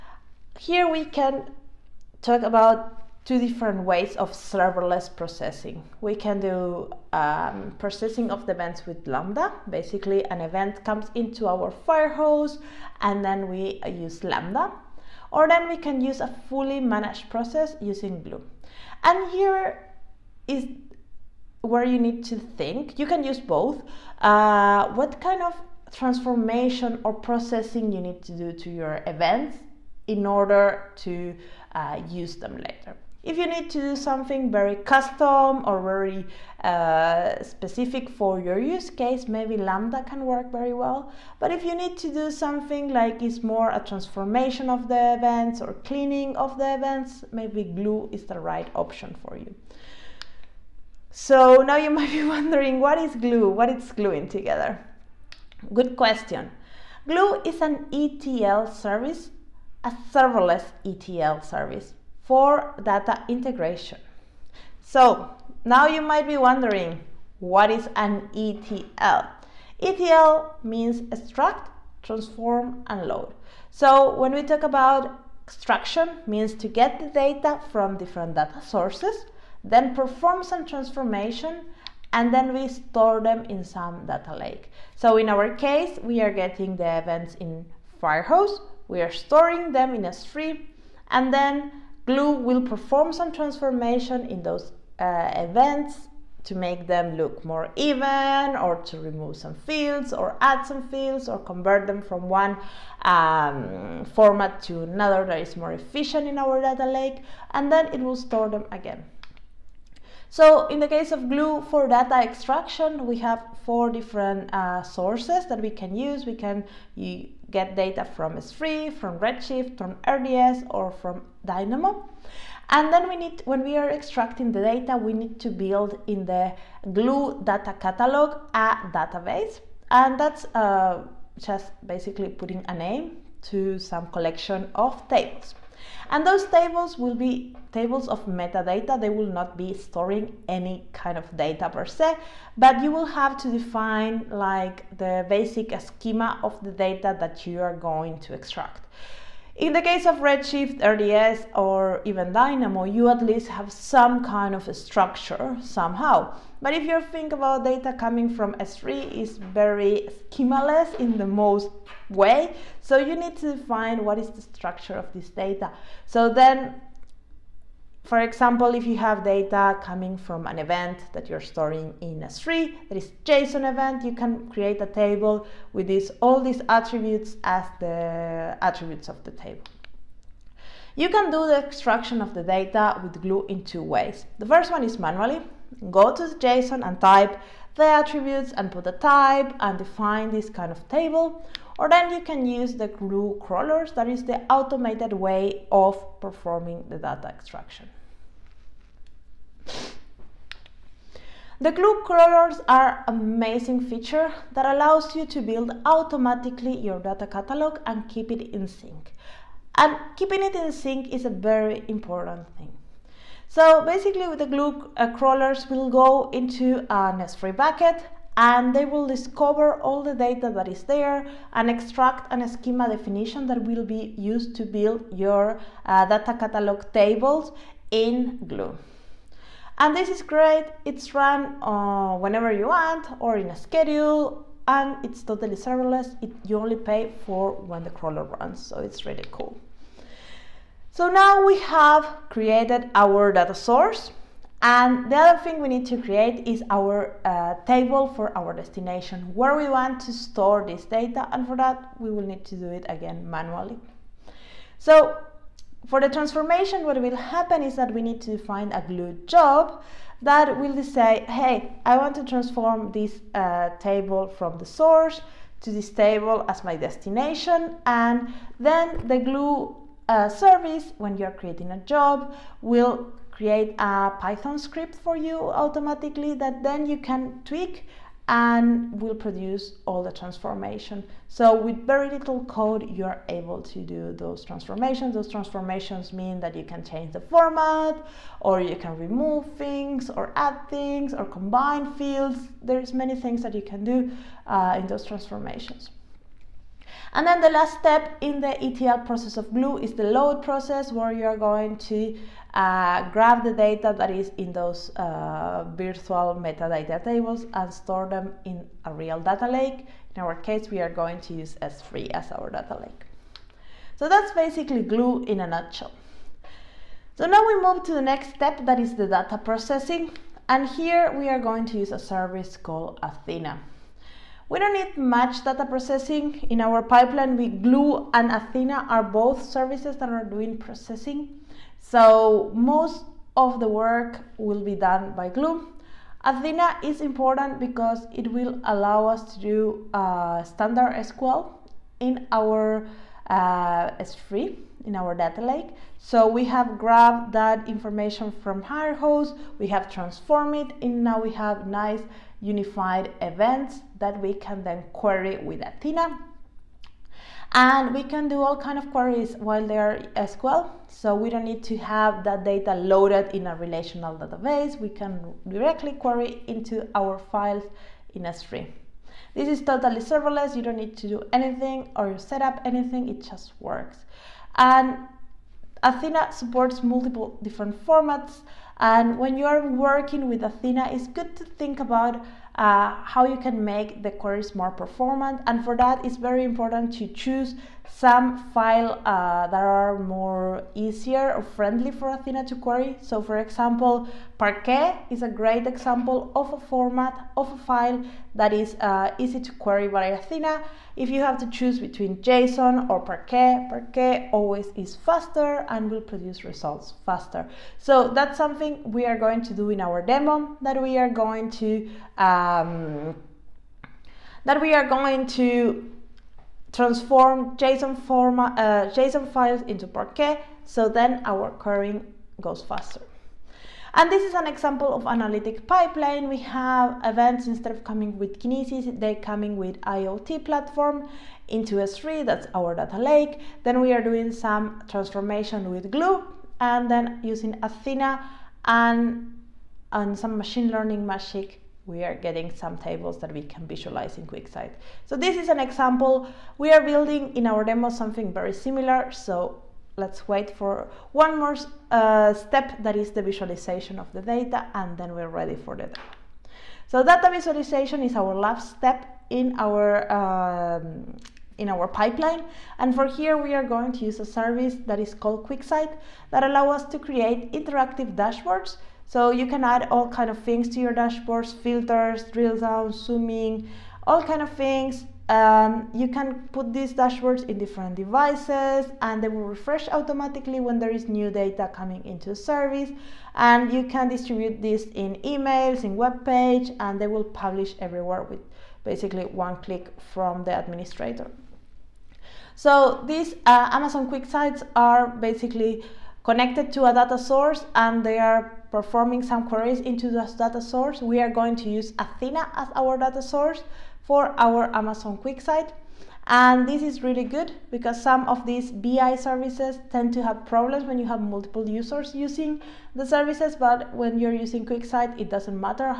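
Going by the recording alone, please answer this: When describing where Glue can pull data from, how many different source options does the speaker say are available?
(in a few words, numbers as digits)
4.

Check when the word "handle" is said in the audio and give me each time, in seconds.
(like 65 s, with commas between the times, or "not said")
not said.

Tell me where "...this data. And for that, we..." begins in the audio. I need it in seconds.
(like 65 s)
250 s.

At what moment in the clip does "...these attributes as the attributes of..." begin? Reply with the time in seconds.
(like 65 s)
176 s.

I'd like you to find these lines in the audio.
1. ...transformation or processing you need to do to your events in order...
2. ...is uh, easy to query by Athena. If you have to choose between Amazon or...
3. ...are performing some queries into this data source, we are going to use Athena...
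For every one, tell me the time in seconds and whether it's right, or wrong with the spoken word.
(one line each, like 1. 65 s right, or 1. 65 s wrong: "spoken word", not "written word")
1. 25 s right
2. 398 s wrong: "JSON", not "Amazon"
3. 498 s right.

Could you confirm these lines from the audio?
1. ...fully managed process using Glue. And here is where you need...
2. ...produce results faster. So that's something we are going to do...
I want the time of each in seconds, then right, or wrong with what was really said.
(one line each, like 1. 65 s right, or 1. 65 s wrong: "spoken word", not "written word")
1. 16 s right
2. 406 s right.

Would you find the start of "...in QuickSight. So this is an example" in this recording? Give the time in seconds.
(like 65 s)
444 s.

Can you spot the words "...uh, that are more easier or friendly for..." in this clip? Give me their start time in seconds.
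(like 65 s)
389 s.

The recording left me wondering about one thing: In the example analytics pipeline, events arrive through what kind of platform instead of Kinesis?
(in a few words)
IoT platform.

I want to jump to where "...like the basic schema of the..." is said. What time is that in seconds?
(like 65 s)
144 s.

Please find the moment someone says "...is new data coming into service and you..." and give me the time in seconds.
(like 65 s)
480 s.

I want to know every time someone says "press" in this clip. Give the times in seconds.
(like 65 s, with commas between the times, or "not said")
not said.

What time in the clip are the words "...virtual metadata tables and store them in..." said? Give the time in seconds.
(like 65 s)
305 s.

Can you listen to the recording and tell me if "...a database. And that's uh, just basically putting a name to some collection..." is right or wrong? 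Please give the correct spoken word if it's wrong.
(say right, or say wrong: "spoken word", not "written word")
right.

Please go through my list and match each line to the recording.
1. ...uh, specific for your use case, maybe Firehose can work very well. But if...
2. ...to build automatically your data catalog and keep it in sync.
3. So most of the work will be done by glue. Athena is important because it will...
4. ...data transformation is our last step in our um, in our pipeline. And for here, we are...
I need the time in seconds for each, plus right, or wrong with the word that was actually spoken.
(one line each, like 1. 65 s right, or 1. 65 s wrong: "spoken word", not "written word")
1. 36 s wrong: "Lambda", not "Firehose"
2. 205 s right
3. 331 s right
4. 457 s wrong: "visualization", not "transformation".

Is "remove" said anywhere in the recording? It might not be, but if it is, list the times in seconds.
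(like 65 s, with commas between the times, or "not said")
98 s, 288 s.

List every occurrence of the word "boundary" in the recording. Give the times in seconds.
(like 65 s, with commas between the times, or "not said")
not said.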